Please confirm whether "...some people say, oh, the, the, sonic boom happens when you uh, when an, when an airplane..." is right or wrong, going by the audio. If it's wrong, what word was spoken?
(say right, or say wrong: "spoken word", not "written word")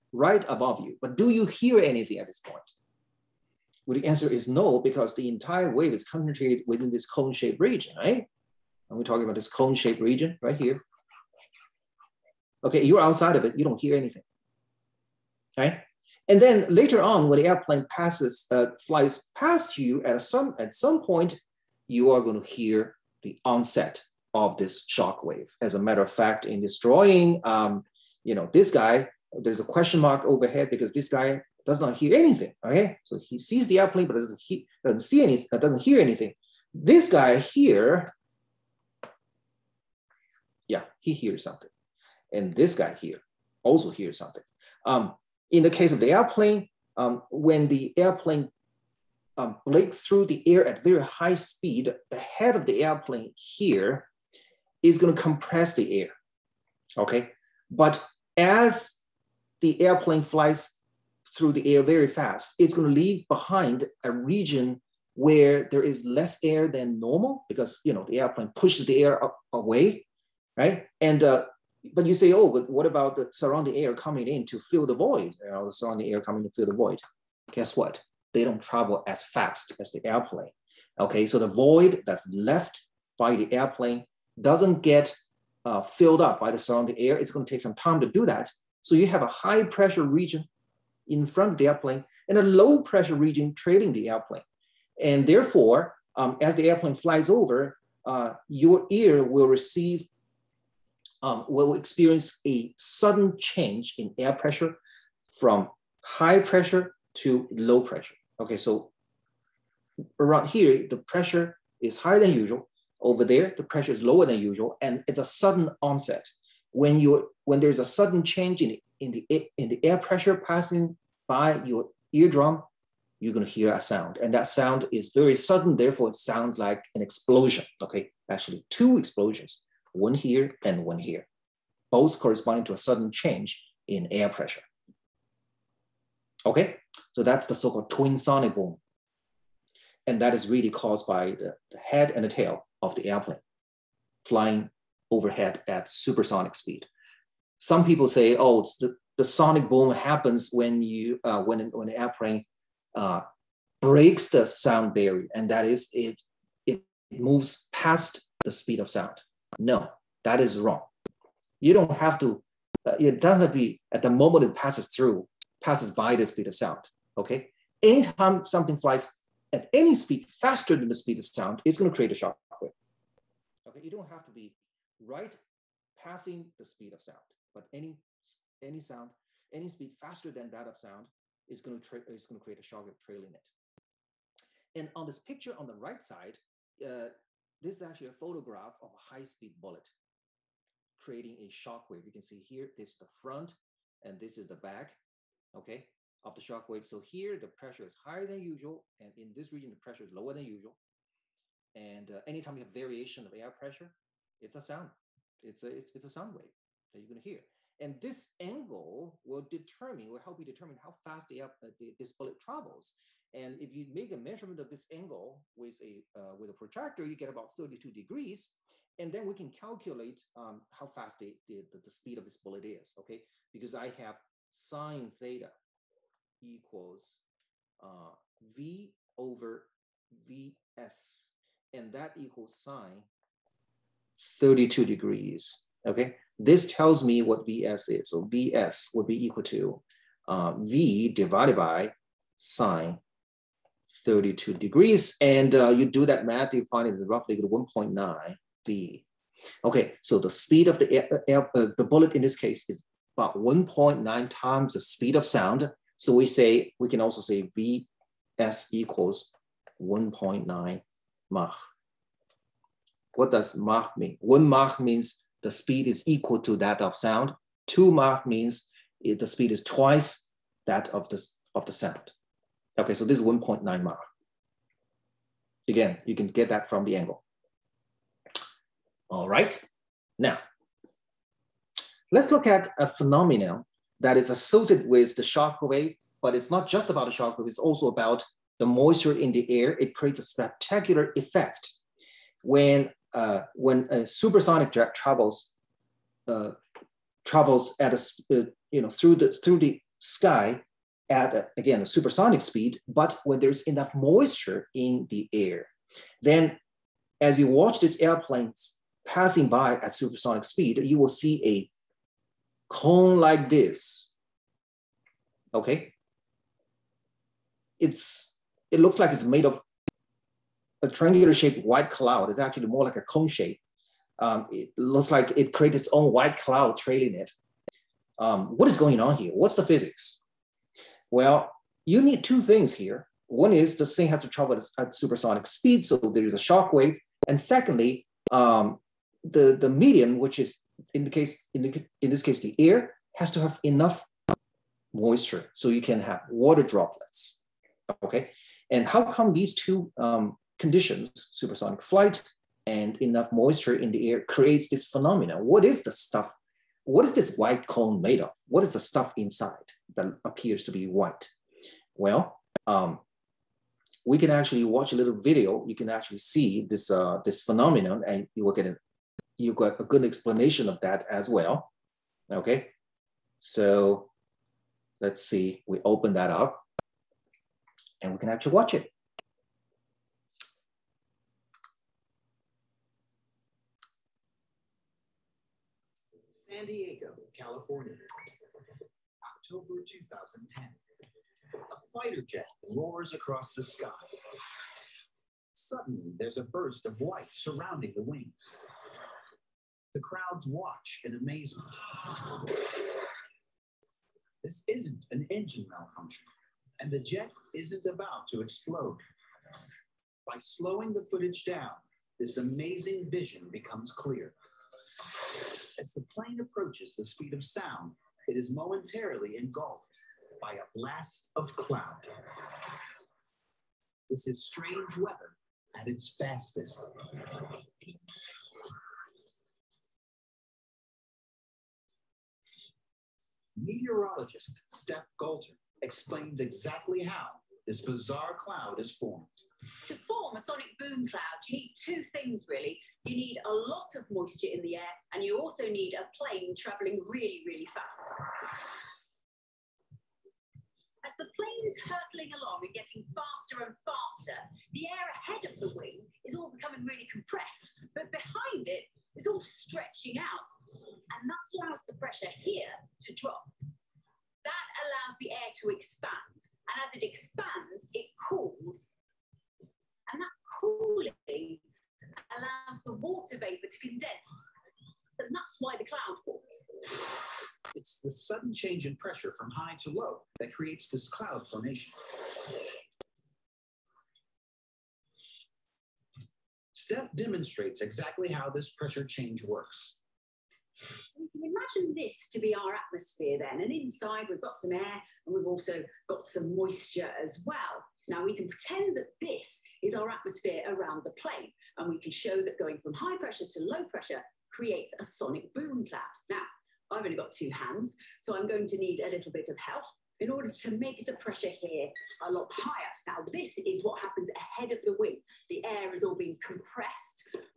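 right.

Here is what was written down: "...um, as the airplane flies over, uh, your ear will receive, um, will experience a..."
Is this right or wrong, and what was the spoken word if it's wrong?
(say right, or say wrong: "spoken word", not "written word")
right.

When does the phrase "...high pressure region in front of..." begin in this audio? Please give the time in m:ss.
1:29.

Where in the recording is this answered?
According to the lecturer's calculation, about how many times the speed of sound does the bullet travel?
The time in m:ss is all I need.
4:07.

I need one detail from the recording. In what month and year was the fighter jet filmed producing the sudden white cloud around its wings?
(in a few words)
October 2010.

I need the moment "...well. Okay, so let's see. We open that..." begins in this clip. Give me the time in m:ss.
6:11.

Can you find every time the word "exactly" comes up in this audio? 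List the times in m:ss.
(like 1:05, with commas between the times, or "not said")
7:16, 8:07.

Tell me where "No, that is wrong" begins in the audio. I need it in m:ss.
2:39.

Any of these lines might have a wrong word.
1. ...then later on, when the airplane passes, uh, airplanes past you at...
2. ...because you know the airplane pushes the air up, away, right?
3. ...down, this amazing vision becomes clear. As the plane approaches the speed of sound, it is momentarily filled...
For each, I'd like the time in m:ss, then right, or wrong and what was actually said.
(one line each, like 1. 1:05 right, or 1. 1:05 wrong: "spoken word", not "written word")
1. 0:16 wrong: "flies", not "airplanes"
2. 1:07 right
3. 6:51 wrong: "engulfed", not "filled".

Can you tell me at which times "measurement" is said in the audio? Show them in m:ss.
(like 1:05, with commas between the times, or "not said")
3:34.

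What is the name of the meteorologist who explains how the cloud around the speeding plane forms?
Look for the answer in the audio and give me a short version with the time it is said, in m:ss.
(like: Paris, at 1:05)
Steph Galter, at 7:14.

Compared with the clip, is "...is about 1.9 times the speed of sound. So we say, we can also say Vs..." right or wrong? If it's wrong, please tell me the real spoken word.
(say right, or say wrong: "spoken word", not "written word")
right.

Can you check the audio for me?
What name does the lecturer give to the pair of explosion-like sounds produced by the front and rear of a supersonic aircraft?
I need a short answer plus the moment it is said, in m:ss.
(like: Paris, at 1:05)
twin sonic boom, at 2:17.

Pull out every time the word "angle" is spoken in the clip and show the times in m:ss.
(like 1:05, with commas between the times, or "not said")
3:28, 3:34, 4:36.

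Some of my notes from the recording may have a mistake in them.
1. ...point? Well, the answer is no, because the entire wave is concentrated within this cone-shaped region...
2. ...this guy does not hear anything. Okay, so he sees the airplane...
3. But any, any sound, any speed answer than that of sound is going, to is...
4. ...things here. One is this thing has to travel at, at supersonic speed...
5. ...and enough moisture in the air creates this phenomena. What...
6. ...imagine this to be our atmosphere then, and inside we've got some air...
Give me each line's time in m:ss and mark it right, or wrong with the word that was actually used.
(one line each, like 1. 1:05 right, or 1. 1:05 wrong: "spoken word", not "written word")
1. 0:02 right
2. 0:30 right
3. 2:57 wrong: "faster", not "answer"
4. 5:32 right
5. 5:52 right
6. 8:11 right.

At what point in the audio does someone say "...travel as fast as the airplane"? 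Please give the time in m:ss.
1:18.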